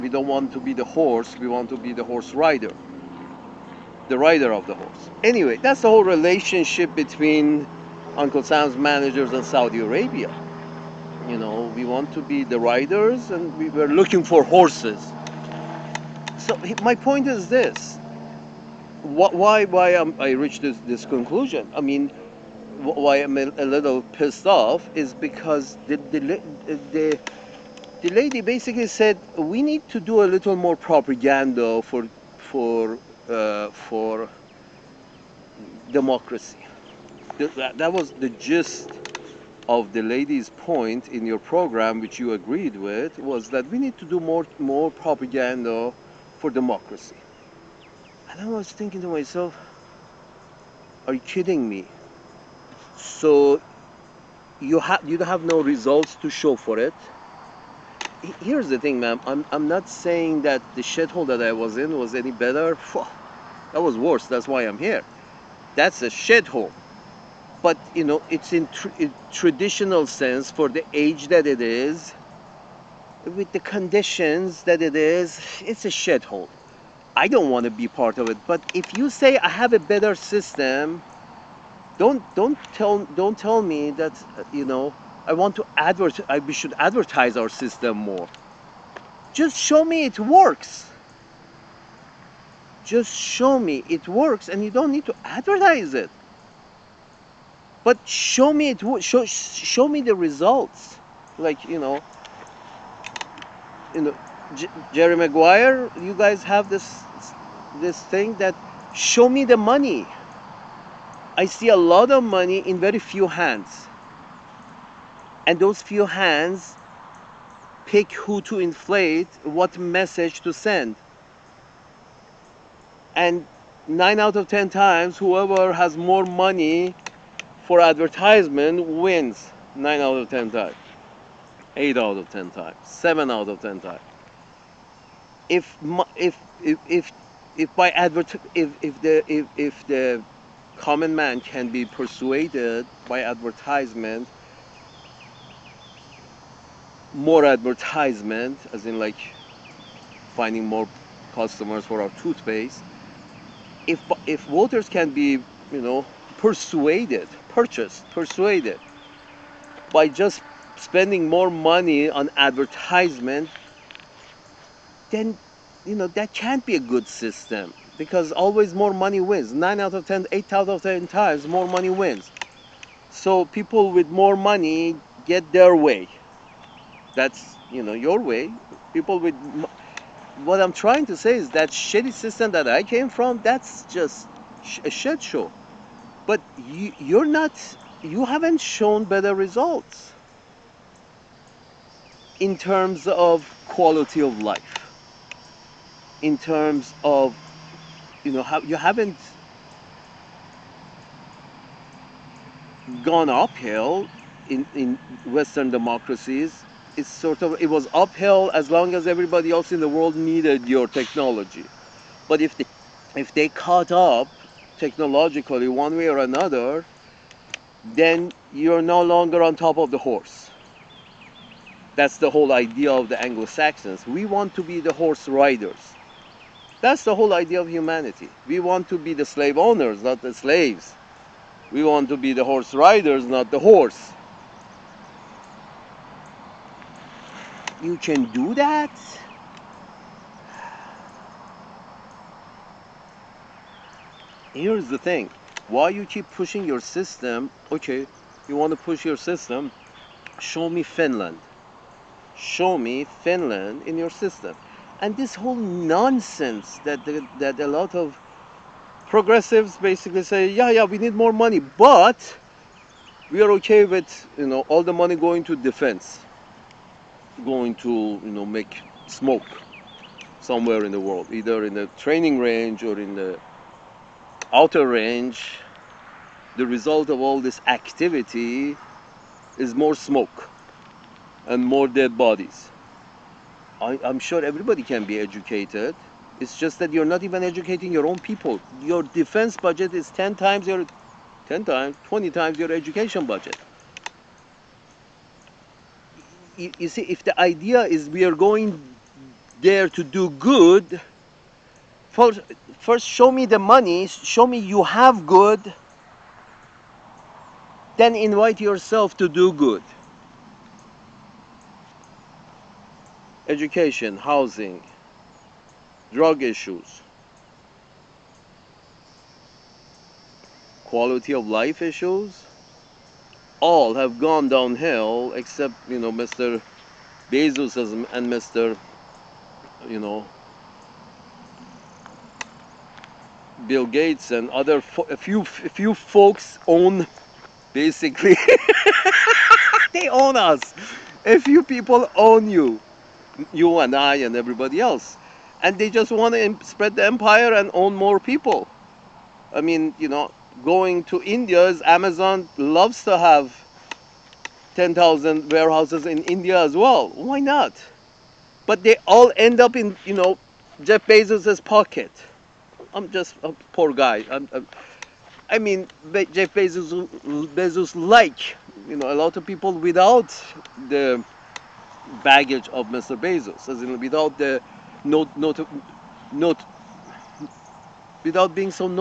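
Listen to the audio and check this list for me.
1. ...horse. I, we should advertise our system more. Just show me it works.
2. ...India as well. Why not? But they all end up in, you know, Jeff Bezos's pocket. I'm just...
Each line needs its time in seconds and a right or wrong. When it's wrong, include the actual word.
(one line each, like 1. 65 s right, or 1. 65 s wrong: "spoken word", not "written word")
1. 85 s wrong: "advertise", not "horse"
2. 356 s right.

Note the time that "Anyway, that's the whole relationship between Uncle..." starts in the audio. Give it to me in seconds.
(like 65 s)
5 s.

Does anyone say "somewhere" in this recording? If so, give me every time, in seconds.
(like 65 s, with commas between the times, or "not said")
270 s.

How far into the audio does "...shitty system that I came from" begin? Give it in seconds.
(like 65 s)
181 s.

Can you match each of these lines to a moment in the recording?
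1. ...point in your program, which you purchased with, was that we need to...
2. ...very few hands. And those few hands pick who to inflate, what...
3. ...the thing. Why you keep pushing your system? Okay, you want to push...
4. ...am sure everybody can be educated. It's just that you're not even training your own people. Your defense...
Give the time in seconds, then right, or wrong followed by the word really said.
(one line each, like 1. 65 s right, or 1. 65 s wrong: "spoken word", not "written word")
1. 40 s wrong: "agreed", not "purchased"
2. 112 s right
3. 244 s right
4. 284 s wrong: "educating", not "training".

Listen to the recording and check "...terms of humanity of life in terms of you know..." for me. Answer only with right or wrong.
wrong.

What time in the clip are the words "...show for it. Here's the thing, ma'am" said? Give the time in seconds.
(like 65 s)
56 s.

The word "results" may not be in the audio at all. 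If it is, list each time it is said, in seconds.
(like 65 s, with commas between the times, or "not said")
55 s, 100 s, 189 s, 276 s.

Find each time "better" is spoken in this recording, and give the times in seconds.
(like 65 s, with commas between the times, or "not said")
62 s, 79 s, 189 s.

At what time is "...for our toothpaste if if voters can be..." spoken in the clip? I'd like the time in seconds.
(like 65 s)
151 s.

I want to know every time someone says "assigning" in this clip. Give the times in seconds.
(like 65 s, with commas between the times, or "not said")
not said.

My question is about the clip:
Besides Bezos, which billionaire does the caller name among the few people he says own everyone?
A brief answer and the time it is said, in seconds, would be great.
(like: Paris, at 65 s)
Bill Gates, at 333 s.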